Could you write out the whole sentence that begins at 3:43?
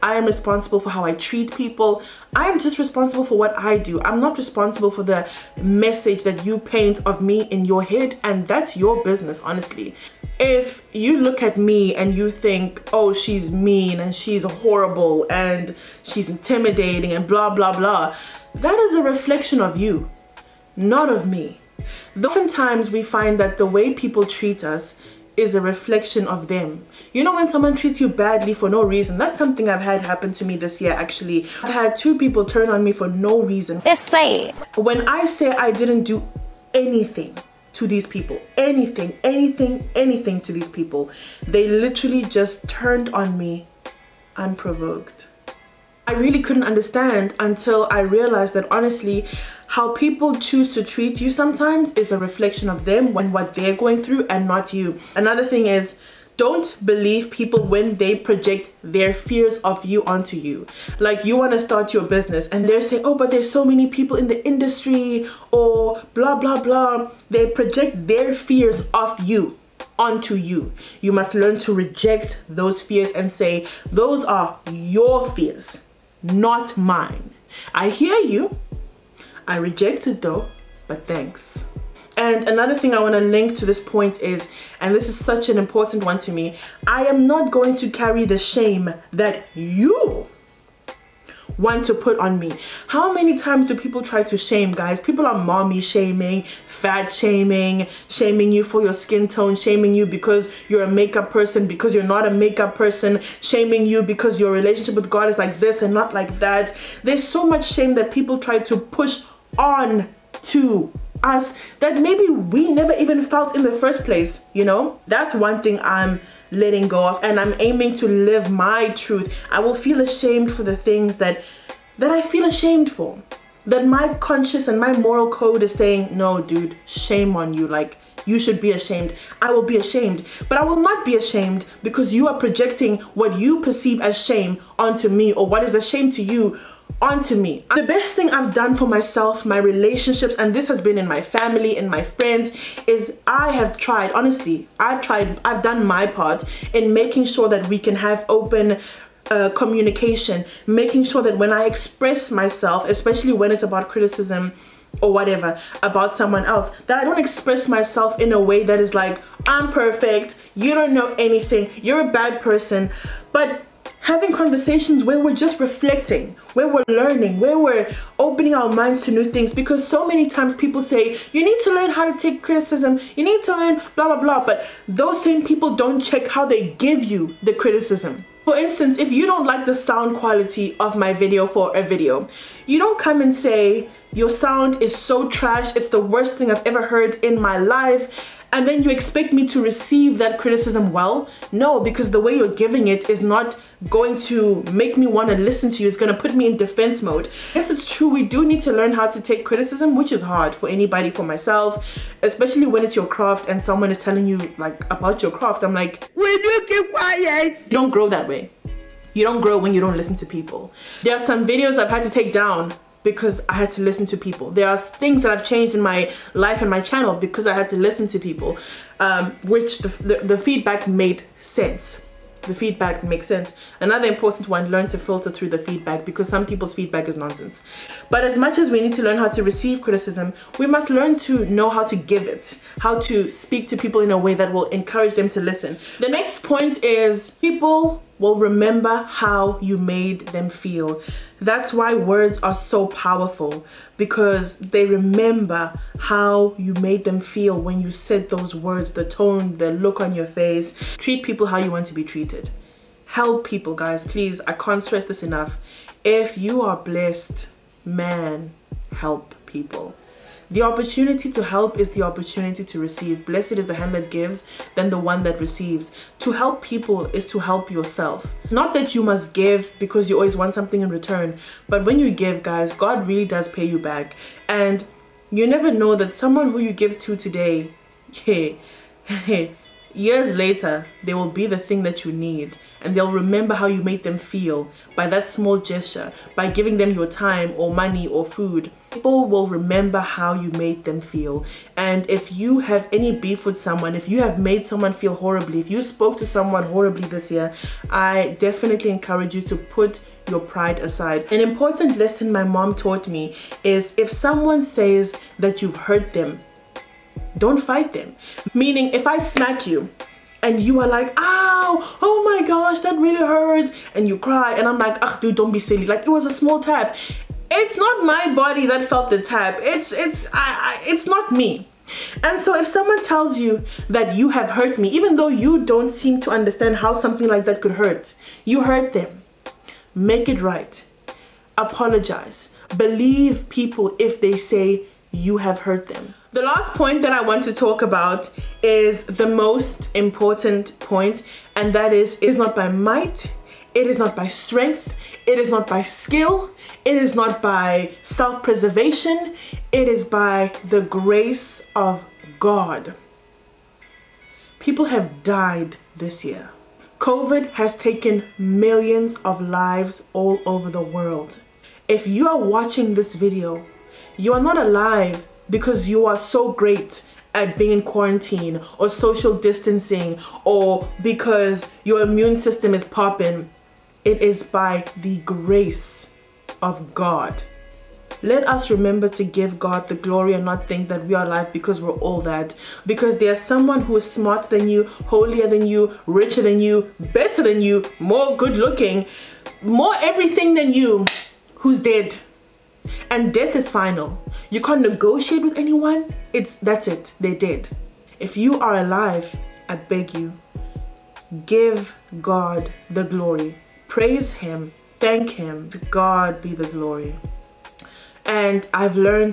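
Another important one, learn to filter through the feedback because some people's feedback is nonsense.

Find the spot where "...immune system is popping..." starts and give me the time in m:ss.
6:12.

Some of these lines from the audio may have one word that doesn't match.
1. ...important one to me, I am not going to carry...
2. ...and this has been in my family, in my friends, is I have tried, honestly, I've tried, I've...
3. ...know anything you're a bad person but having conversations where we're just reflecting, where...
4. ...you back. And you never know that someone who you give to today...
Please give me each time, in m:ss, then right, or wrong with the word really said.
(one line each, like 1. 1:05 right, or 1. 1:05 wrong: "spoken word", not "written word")
1. 1:25 right
2. 2:20 right
3. 2:40 right
4. 4:33 right.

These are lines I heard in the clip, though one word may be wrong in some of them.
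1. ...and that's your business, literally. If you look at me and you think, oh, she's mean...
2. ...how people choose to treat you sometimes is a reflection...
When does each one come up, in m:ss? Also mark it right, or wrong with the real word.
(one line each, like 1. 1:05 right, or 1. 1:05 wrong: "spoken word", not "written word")
1. 0:08 wrong: "honestly", not "literally"
2. 0:49 right.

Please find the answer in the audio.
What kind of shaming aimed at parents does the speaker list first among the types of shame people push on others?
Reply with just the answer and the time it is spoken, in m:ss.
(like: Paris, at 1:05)
Mommy shaming, at 1:35.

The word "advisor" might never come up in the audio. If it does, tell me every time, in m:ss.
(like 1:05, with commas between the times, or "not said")
not said.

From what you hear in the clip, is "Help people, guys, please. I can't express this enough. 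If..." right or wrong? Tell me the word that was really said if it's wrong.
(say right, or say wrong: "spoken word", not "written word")
wrong: "stress", not "express".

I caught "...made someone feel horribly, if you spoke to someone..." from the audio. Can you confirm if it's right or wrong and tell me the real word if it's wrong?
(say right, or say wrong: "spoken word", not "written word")
right.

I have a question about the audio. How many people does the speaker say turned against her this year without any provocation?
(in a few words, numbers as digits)
2.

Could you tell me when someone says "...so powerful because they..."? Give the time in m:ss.
4:02.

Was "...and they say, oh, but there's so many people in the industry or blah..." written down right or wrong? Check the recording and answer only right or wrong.
right.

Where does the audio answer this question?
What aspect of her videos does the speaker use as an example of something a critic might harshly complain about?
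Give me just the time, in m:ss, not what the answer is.
2:59.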